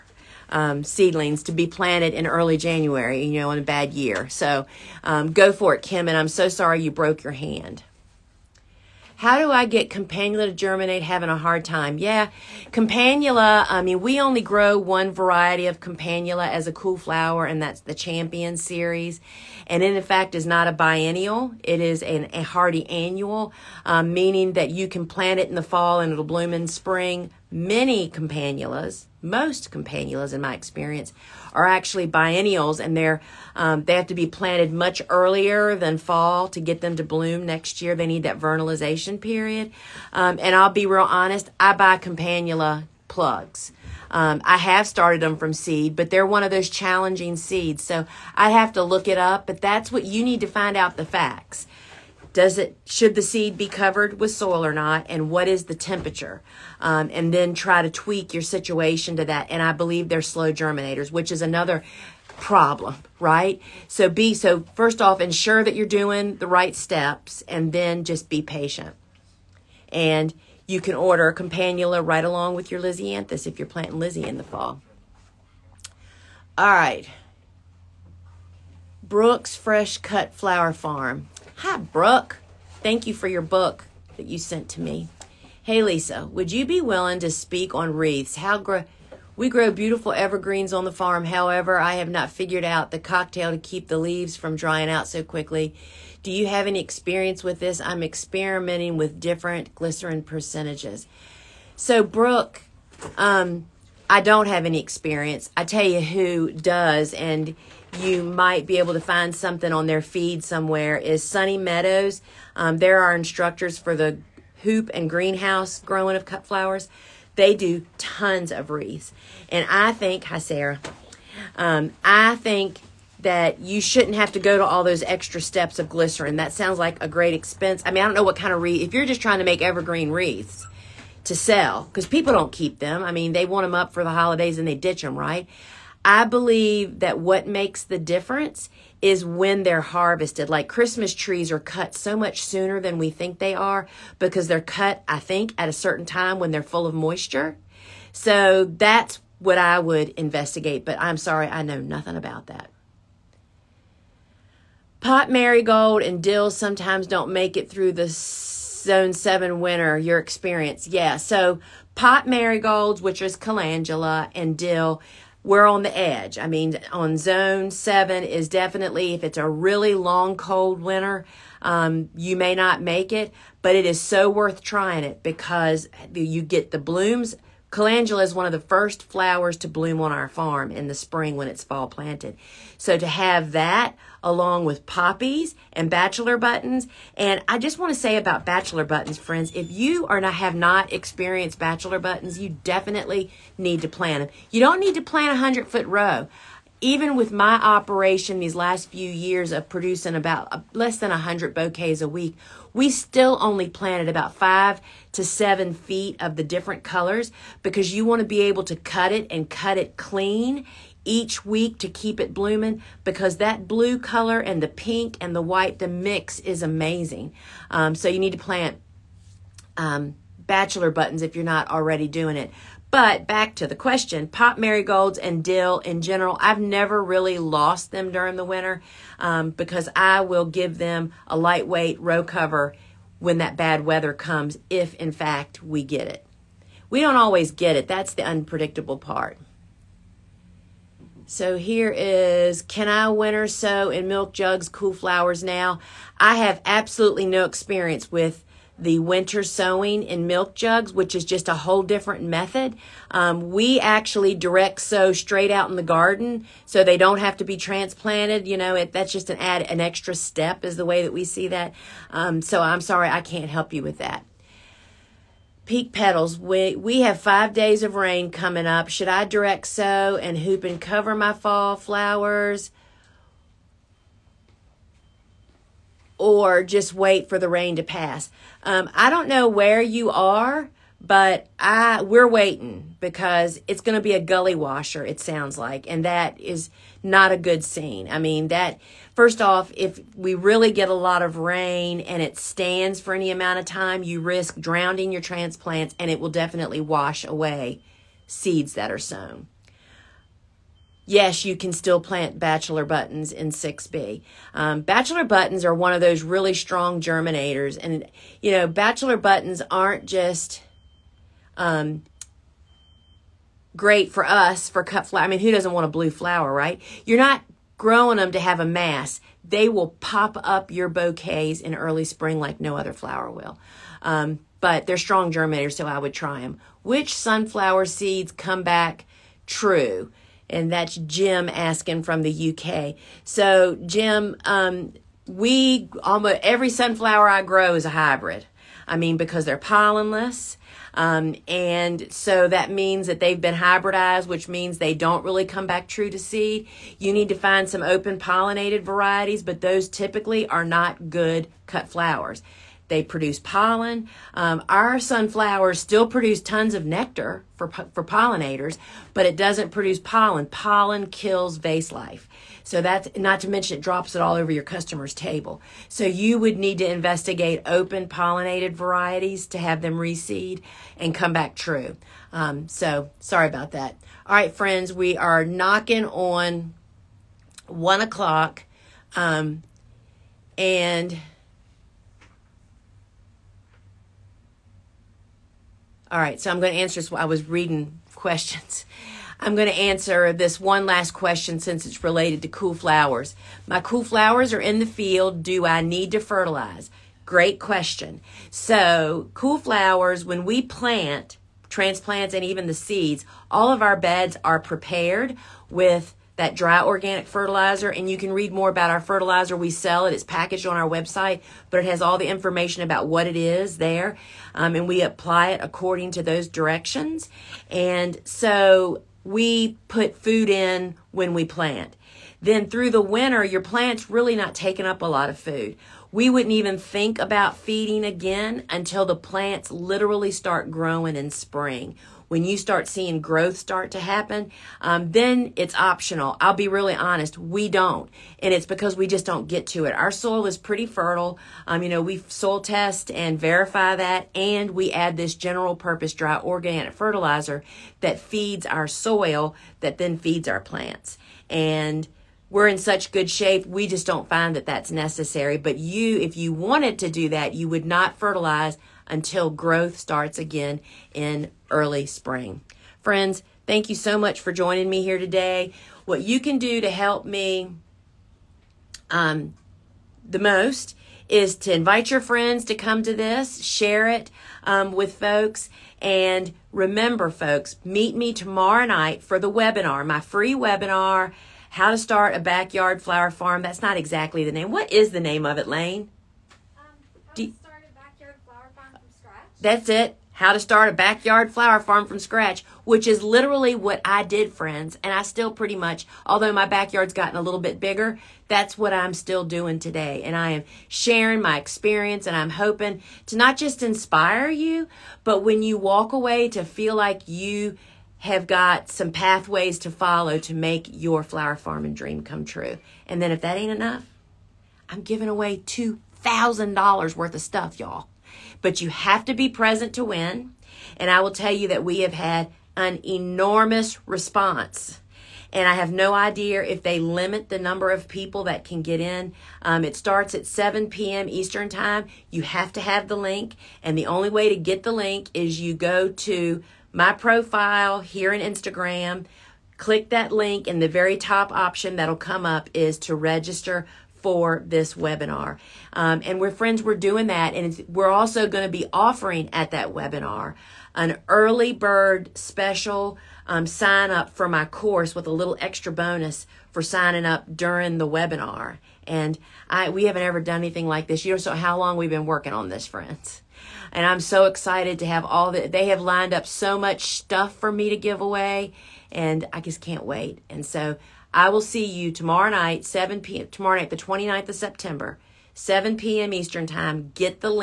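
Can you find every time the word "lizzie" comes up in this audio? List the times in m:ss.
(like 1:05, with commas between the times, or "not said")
1:13.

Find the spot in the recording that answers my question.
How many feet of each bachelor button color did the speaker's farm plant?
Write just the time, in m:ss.
3:24.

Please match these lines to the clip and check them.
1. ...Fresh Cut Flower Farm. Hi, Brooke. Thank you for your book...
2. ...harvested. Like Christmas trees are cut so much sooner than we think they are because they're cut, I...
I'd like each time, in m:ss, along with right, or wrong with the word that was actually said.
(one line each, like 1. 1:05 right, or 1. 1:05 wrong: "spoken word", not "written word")
1. 1:19 right
2. 2:19 right.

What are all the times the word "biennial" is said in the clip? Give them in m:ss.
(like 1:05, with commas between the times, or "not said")
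0:20, 0:32.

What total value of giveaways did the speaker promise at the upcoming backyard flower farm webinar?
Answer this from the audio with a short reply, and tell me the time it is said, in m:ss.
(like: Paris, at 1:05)
$2,000, at 8:35.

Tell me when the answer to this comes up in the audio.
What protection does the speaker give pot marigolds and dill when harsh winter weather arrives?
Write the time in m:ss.
3:51.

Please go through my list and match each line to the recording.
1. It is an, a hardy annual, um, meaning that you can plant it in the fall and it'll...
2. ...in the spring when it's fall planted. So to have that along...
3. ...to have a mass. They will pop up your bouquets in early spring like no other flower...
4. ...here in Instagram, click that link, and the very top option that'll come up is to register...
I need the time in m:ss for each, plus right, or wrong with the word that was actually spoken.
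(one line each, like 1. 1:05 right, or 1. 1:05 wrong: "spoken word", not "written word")
1. 0:21 right
2. 3:00 right
3. 5:18 right
4. 8:58 right.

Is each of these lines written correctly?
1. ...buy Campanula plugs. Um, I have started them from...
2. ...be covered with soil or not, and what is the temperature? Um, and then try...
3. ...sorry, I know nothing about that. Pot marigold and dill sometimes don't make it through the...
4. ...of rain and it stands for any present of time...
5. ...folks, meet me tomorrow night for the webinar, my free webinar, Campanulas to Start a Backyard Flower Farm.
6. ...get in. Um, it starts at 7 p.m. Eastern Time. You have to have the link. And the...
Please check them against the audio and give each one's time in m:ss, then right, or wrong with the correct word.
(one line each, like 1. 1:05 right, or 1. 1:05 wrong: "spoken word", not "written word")
1. 0:41 right
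2. 0:53 right
3. 2:31 right
4. 4:51 wrong: "amount", not "present"
5. 7:57 wrong: "How", not "Campanulas"
6. 8:48 right.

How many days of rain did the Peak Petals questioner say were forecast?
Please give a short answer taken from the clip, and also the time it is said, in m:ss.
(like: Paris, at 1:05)
5, at 4:27.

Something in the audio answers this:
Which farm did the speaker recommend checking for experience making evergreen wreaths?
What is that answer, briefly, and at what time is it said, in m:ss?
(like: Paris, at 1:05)
Sunny Meadows, at 1:51.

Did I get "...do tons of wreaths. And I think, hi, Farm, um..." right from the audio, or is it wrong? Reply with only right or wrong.
wrong.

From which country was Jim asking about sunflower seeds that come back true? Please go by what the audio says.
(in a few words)
UK.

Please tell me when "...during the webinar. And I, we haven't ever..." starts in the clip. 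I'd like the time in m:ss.
9:17.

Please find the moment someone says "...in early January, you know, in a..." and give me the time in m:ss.
0:02.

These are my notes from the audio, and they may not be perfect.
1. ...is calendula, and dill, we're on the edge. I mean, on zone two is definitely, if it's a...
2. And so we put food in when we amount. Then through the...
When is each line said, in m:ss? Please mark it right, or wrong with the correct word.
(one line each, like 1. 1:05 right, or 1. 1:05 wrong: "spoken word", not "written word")
1. 2:43 wrong: "seven", not "two"
2. 6:57 wrong: "plant", not "amount".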